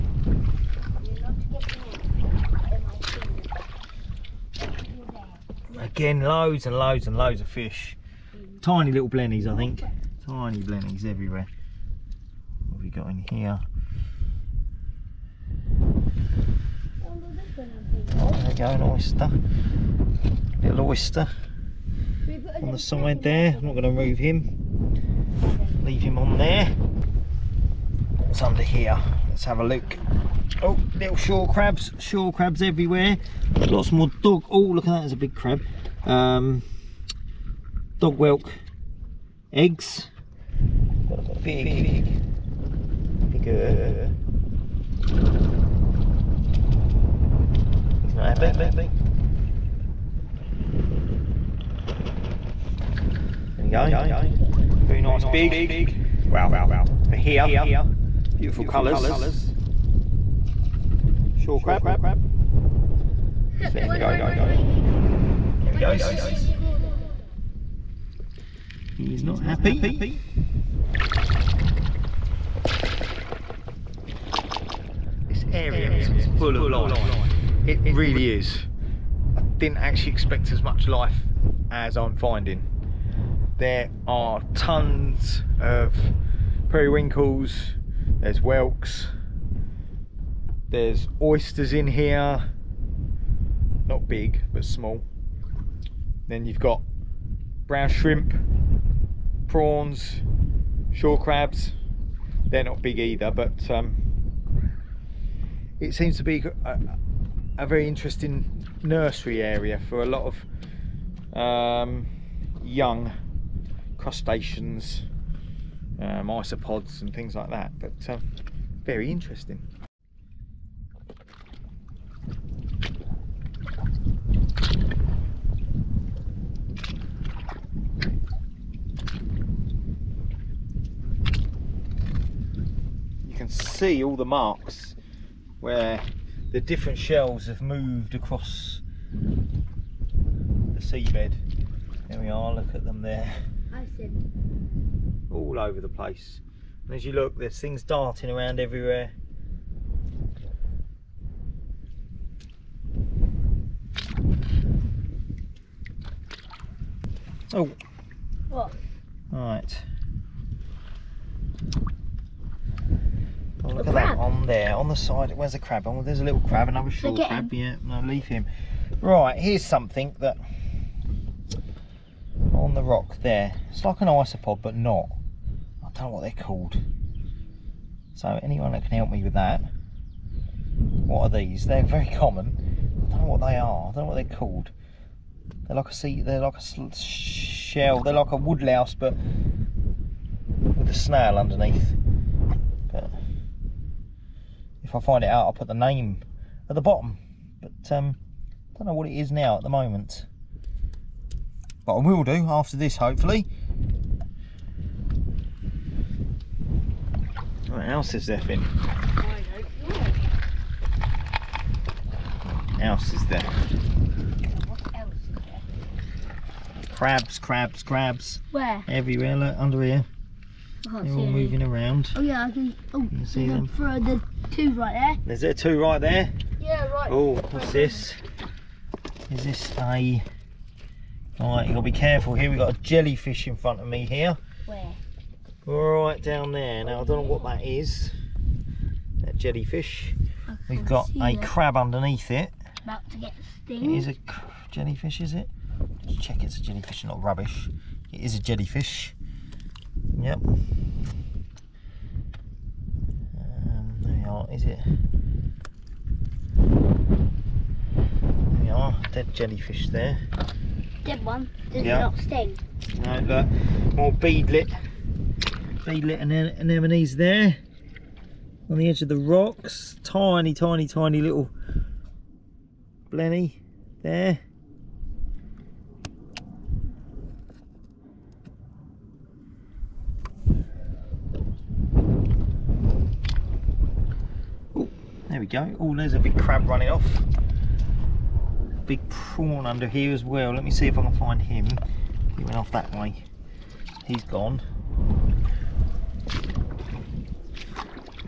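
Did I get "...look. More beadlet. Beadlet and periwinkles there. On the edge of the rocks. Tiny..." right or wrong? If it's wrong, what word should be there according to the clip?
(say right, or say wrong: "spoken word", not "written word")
wrong: "anemones", not "periwinkles".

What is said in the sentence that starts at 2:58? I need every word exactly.
So anyone that can help me with that.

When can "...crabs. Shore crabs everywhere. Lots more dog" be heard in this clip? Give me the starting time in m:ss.
0:31.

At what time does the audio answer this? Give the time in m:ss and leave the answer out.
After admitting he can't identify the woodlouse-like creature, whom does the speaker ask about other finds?
3:28.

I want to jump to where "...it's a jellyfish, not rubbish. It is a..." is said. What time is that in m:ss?
4:06.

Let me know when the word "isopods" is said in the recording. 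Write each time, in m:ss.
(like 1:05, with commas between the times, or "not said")
1:56, 2:54.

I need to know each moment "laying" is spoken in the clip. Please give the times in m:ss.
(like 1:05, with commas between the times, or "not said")
not said.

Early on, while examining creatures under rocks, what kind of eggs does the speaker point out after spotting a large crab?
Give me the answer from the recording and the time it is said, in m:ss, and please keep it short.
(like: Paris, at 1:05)
dog whelk eggs, at 0:38.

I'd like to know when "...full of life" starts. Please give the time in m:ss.
1:16.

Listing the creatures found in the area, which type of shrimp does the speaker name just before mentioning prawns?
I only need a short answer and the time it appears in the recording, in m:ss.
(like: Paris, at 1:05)
brown shrimp, at 1:37.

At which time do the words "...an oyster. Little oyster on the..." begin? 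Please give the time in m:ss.
0:18.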